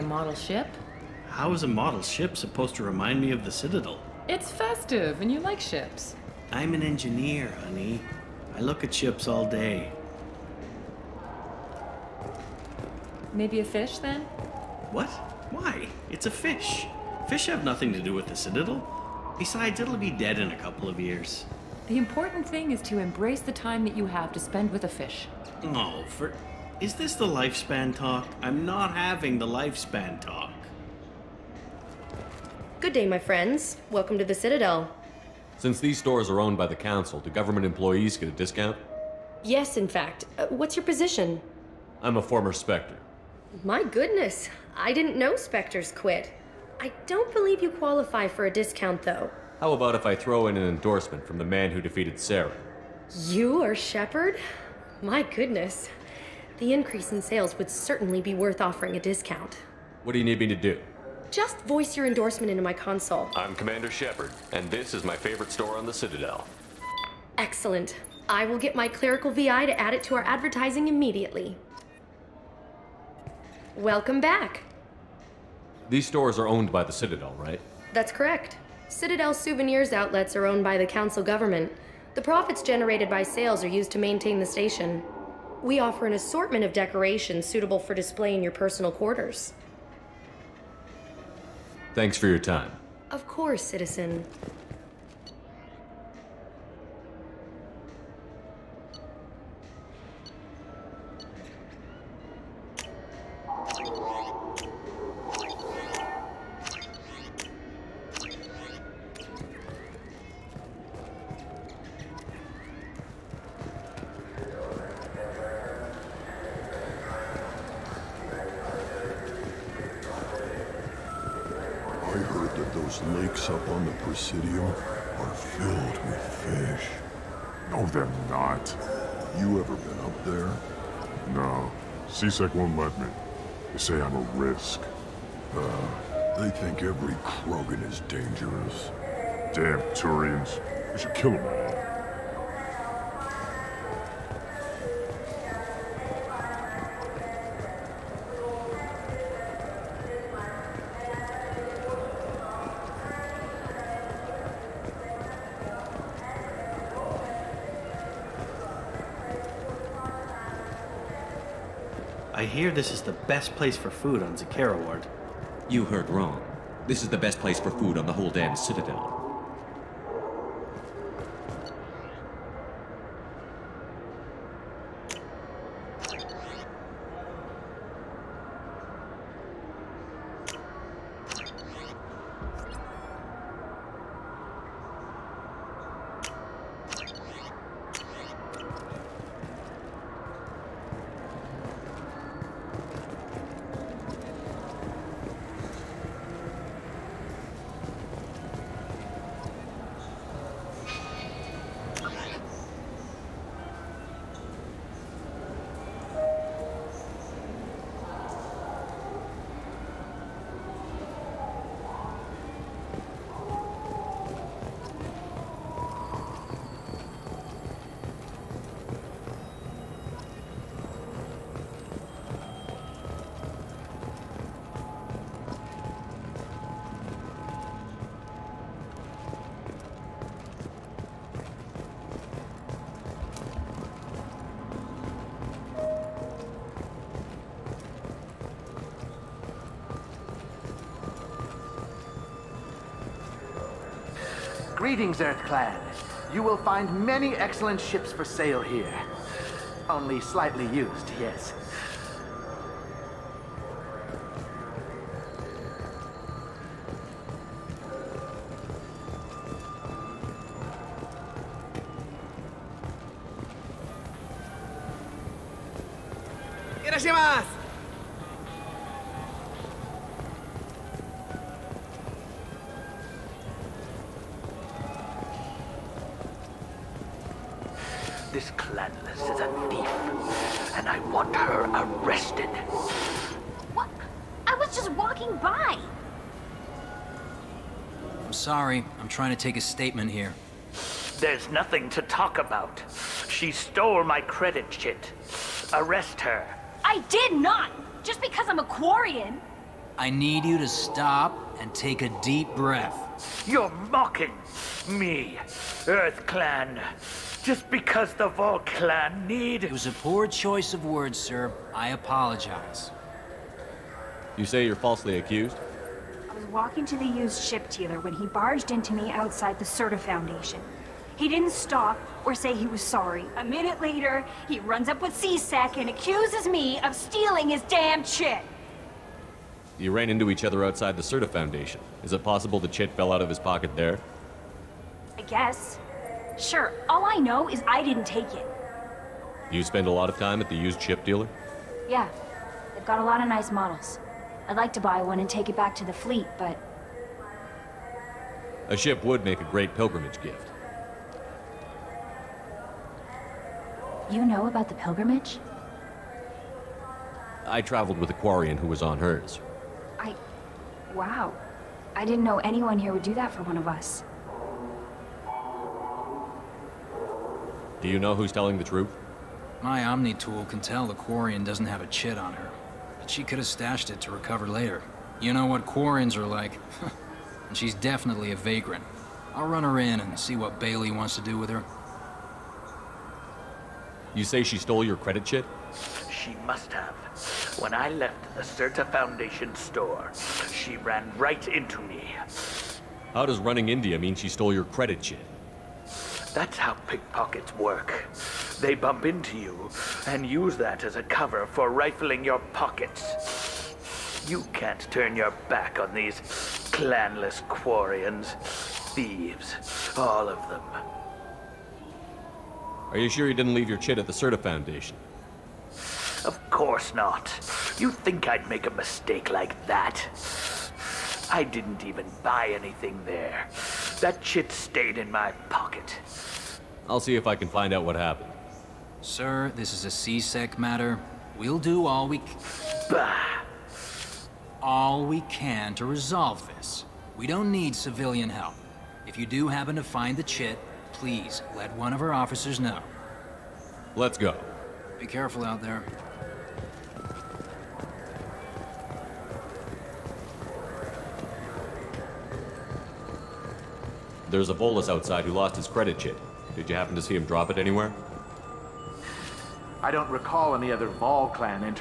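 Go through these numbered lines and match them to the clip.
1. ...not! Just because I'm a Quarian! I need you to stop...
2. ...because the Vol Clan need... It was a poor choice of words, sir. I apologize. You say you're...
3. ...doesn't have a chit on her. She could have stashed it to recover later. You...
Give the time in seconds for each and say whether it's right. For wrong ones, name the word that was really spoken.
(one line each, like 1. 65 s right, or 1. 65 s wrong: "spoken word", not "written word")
1. 297 s right
2. 307 s right
3. 371 s right.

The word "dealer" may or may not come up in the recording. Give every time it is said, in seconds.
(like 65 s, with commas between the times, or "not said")
317 s, 341 s.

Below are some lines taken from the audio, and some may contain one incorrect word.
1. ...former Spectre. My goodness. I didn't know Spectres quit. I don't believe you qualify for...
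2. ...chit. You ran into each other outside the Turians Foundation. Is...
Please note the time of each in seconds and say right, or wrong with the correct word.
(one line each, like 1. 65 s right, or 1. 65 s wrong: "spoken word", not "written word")
1. 42 s right
2. 328 s wrong: "Sirta", not "Turians".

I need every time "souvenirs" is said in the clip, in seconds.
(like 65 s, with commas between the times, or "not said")
79 s.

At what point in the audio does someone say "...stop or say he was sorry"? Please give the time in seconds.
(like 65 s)
321 s.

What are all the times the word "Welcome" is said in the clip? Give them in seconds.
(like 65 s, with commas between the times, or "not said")
33 s, 73 s.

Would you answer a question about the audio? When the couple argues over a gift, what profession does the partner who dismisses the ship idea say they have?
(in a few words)
Engineer.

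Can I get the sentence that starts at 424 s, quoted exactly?
That chit stayed in my pocket.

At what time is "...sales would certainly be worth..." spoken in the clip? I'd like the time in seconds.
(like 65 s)
57 s.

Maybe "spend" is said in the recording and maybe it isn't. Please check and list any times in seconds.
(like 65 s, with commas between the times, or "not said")
24 s, 339 s.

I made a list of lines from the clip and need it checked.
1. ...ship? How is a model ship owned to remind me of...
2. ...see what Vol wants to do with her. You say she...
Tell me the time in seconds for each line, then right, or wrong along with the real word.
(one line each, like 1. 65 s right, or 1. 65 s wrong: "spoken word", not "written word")
1. 0 s wrong: "supposed", not "owned"
2. 380 s wrong: "Bailey", not "Vol".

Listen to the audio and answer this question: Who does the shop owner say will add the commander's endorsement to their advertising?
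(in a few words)
Clerical VI.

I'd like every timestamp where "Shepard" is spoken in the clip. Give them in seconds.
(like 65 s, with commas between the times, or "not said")
53 s, 63 s.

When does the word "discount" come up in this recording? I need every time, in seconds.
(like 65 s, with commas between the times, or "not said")
38 s, 48 s, 58 s.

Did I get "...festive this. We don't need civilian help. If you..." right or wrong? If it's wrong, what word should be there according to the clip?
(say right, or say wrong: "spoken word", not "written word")
wrong: "resolve", not "festive".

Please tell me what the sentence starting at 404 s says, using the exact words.
You can't turn your back on these clanless Quarians.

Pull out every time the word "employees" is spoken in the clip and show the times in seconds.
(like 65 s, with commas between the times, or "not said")
37 s.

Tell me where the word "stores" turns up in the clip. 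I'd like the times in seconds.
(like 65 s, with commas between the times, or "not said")
35 s, 65 s, 76 s, 389 s.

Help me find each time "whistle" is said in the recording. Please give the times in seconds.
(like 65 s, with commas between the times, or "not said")
not said.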